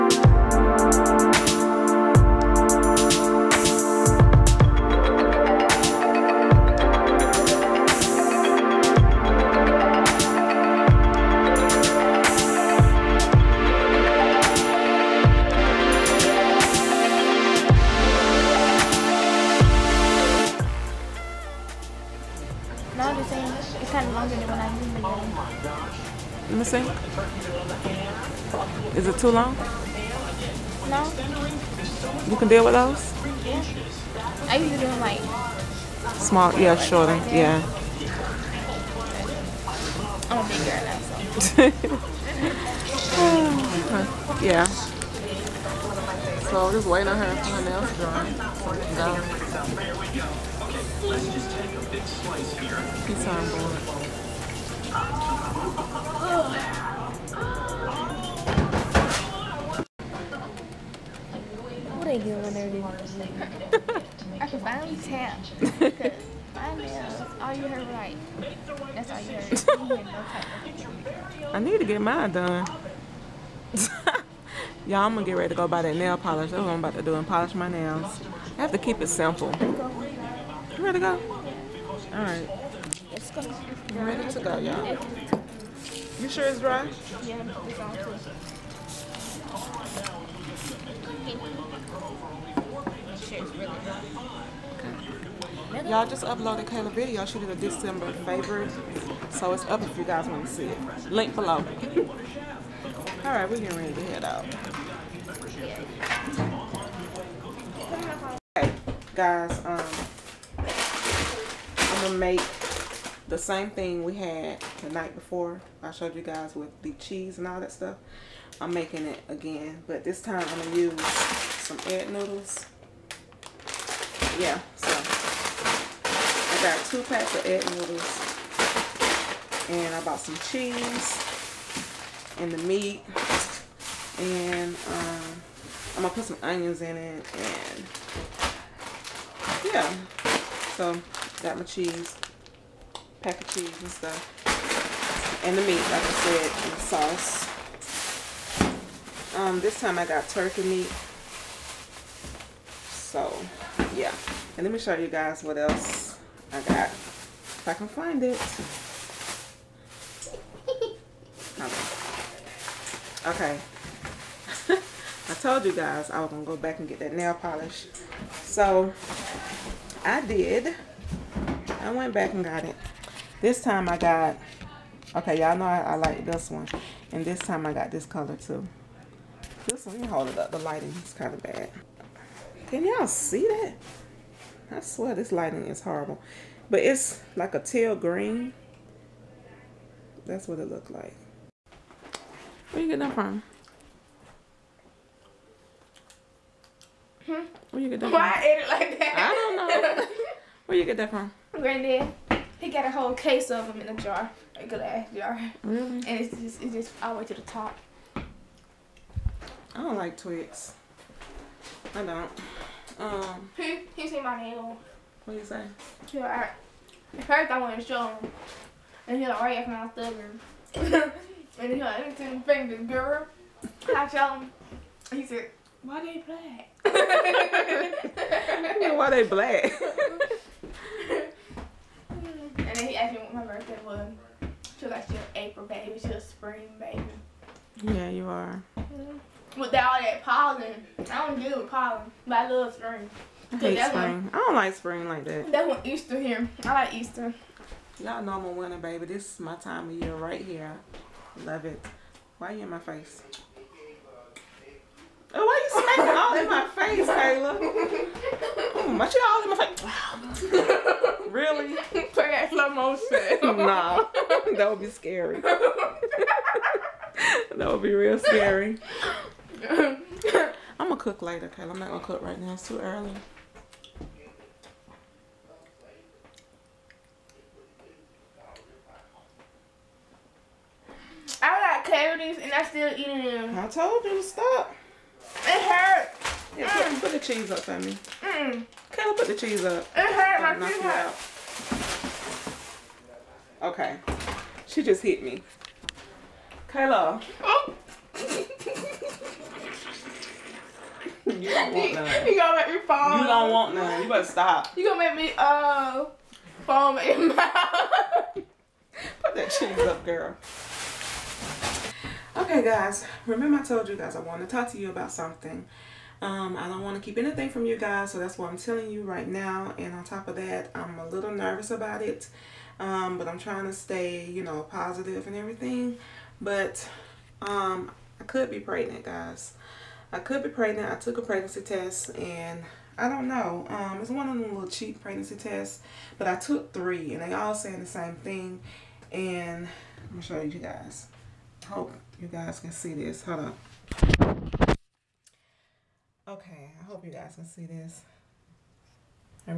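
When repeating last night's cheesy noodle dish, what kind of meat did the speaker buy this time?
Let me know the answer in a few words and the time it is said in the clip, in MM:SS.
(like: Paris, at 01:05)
turkey meat, at 02:30.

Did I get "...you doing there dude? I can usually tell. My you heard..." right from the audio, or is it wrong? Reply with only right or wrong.
wrong.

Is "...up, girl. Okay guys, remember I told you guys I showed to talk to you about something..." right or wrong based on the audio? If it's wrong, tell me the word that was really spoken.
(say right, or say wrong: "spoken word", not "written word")
wrong: "wanted", not "showed".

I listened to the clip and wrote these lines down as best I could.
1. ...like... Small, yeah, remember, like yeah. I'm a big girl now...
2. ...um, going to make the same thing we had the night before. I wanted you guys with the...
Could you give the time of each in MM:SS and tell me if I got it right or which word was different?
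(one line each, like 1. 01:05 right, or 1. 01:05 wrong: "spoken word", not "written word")
1. 00:34 wrong: "shorter", not "remember"
2. 01:49 wrong: "showed", not "wanted".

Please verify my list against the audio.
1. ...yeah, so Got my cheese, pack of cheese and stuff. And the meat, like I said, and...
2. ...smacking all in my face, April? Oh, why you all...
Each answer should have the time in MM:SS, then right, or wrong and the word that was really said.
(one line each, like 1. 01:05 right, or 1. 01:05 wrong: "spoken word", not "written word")
1. 02:19 right
2. 04:17 wrong: "Kayla", not "April".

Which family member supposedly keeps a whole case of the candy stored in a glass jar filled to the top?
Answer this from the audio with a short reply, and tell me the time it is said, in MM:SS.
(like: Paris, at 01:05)
Granddad, at 03:21.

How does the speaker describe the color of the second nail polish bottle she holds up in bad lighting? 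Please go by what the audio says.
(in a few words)
teal green.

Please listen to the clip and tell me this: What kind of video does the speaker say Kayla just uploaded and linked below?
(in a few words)
December favorite.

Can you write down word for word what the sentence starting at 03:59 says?
Without all that pollen, I don't deal with pollen, but I love spring.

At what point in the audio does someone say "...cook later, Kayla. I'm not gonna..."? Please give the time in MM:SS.
04:30.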